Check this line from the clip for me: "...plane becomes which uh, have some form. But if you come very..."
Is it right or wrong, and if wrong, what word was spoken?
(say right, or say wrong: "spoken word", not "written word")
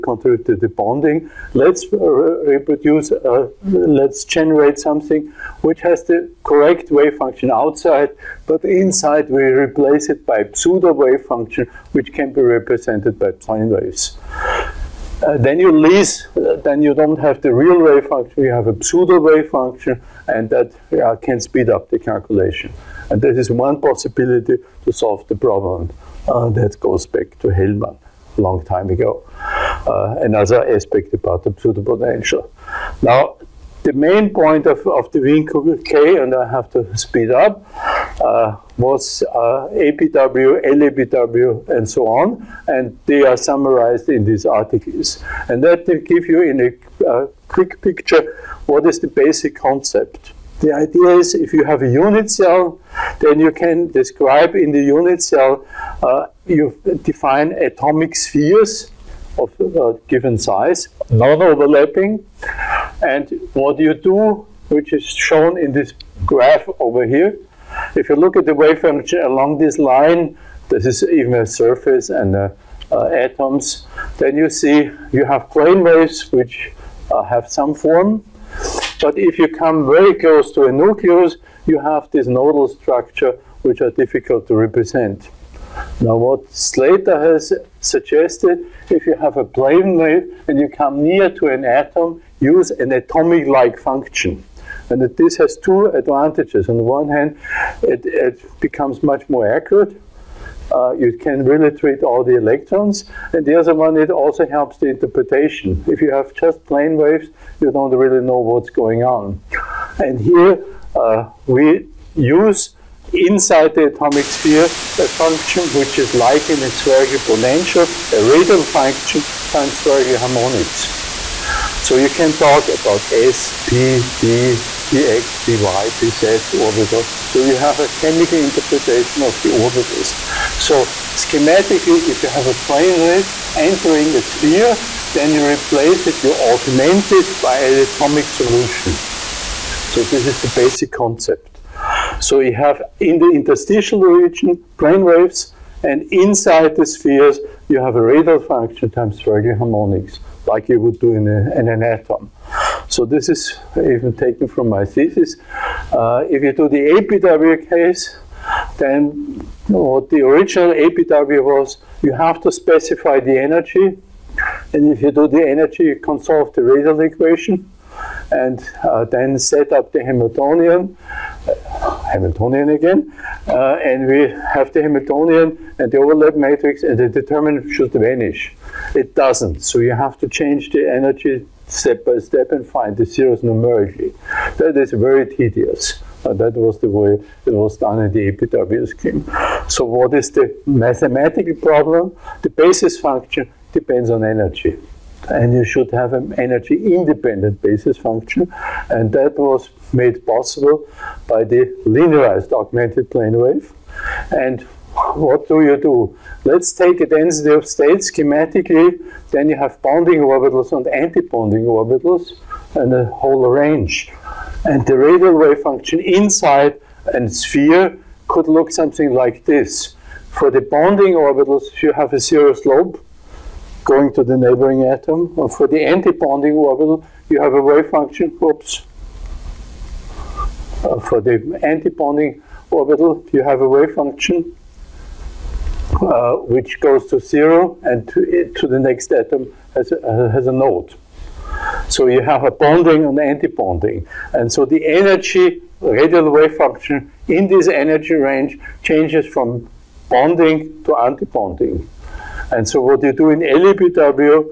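wrong: "waves", not "becomes".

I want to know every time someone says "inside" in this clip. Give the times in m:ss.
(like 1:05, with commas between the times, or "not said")
0:08, 1:53, 2:26, 3:35.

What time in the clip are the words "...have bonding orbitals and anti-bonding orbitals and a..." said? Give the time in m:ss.
3:29.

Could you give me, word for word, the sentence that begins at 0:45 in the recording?
And that will give you in a uh, quick picture what is the basic concept.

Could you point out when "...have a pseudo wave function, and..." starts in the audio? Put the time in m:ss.
0:18.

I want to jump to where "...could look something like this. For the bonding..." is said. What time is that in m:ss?
3:38.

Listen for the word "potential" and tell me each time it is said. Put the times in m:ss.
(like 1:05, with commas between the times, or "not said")
0:31, 1:57.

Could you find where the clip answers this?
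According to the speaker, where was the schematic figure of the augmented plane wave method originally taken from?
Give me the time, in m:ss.
2:34.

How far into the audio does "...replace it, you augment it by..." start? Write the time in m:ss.
2:15.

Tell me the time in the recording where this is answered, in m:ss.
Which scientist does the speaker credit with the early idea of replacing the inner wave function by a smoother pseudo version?
0:27.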